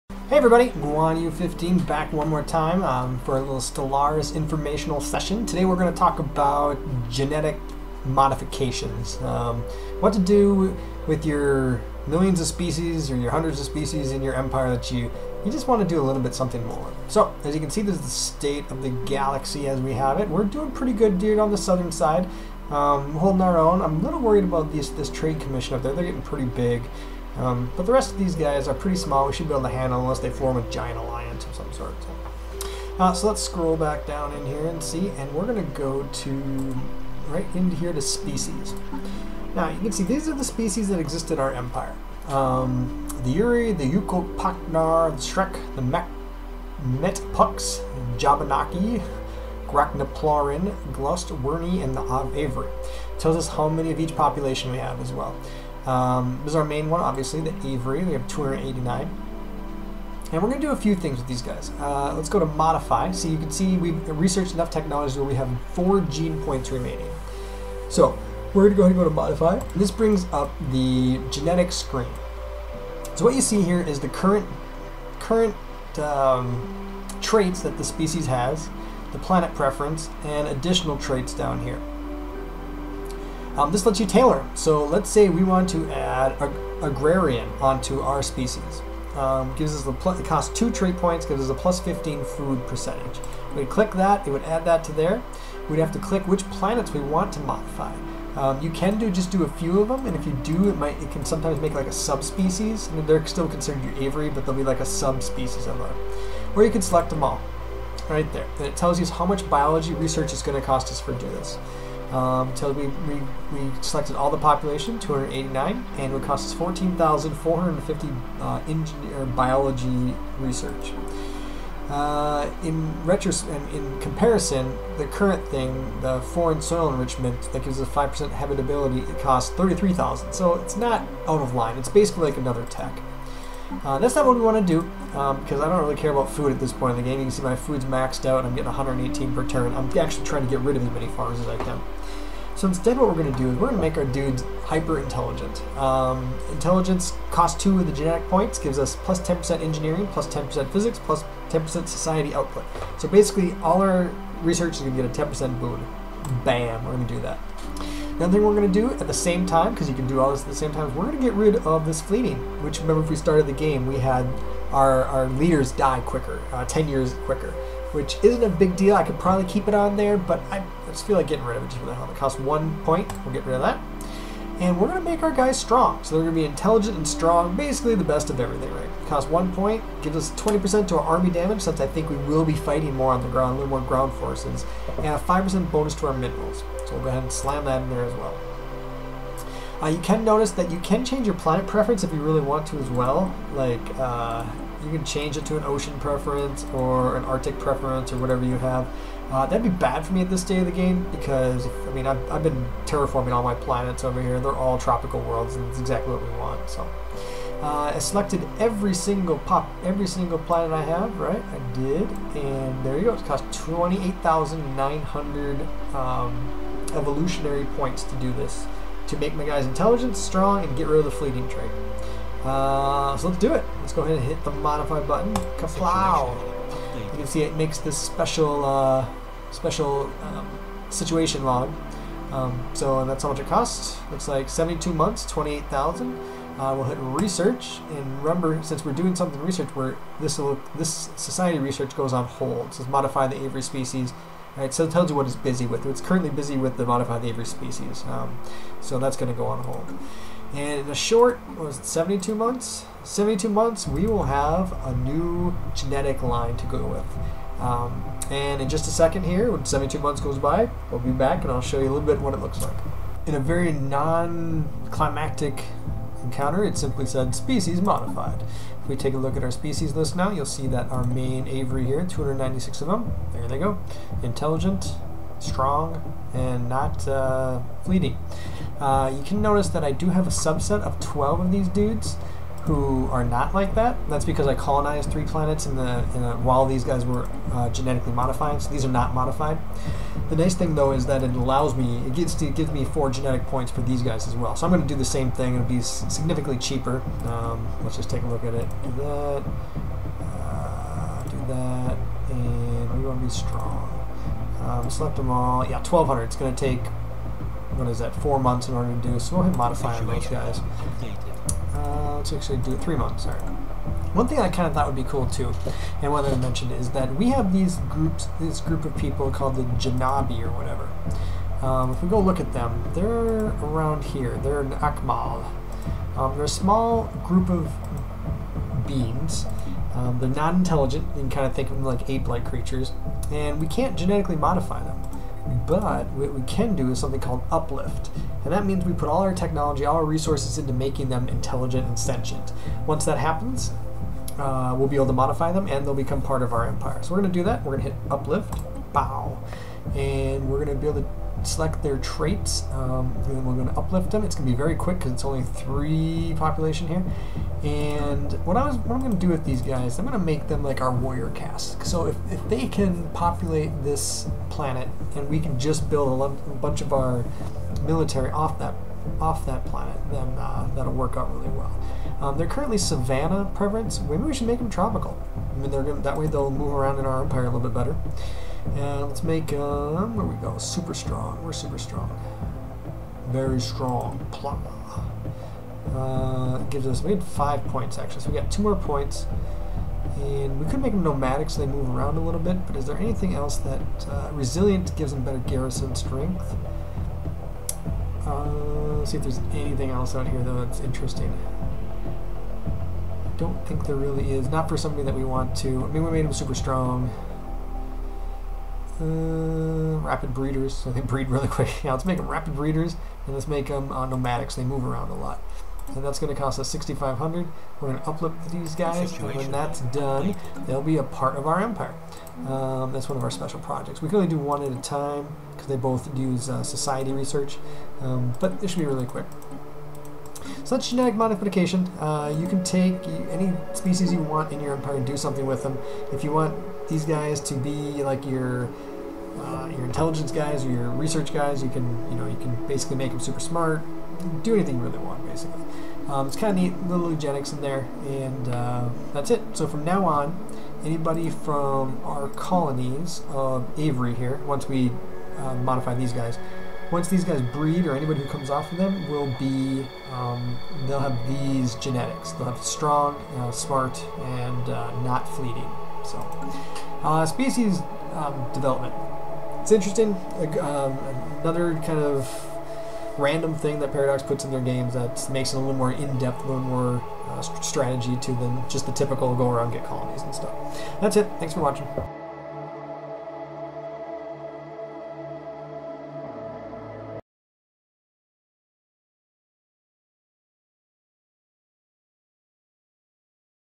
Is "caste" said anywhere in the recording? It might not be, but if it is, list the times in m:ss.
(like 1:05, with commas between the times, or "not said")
6:01.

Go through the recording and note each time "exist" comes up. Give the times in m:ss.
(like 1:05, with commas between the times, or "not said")
0:40.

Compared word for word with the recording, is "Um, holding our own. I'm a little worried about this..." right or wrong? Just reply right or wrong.
right.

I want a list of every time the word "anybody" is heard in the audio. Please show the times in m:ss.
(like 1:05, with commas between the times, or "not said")
7:30, 7:37.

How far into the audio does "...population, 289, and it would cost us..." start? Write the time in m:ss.
1:54.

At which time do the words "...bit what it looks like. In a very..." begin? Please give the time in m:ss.
4:22.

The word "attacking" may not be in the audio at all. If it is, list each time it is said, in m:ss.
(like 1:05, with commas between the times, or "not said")
not said.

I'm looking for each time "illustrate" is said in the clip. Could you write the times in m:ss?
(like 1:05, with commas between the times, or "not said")
not said.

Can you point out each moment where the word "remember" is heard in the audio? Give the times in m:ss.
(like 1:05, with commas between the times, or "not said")
2:42, 3:58.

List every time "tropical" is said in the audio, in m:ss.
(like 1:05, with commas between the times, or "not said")
3:24, 6:14.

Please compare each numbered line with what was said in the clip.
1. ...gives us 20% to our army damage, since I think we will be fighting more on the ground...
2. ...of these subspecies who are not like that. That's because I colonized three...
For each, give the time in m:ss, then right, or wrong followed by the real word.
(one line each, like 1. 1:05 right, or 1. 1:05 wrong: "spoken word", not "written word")
1. 3:00 right
2. 4:41 wrong: "dudes", not "subspecies".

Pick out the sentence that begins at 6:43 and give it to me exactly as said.
I don't think there really is.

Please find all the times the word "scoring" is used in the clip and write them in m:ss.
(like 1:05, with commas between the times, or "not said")
not said.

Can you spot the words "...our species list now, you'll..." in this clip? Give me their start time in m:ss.
4:29.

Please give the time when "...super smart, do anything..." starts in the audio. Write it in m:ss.
7:23.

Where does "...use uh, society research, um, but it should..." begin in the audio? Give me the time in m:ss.
7:06.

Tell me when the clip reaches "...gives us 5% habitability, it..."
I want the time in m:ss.
2:07.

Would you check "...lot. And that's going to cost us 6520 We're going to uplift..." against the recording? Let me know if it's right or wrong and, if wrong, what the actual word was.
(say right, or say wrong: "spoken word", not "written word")
wrong: "6500", not "6520".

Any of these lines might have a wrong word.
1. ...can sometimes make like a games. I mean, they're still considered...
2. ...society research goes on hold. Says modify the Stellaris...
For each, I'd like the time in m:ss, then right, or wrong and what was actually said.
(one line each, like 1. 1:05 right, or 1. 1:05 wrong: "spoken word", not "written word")
1. 1:41 wrong: "subspecies", not "games"
2. 4:01 wrong: "Avery", not "Stellaris".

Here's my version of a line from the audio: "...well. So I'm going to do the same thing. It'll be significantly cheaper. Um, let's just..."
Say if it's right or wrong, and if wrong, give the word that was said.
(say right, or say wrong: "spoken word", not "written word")
right.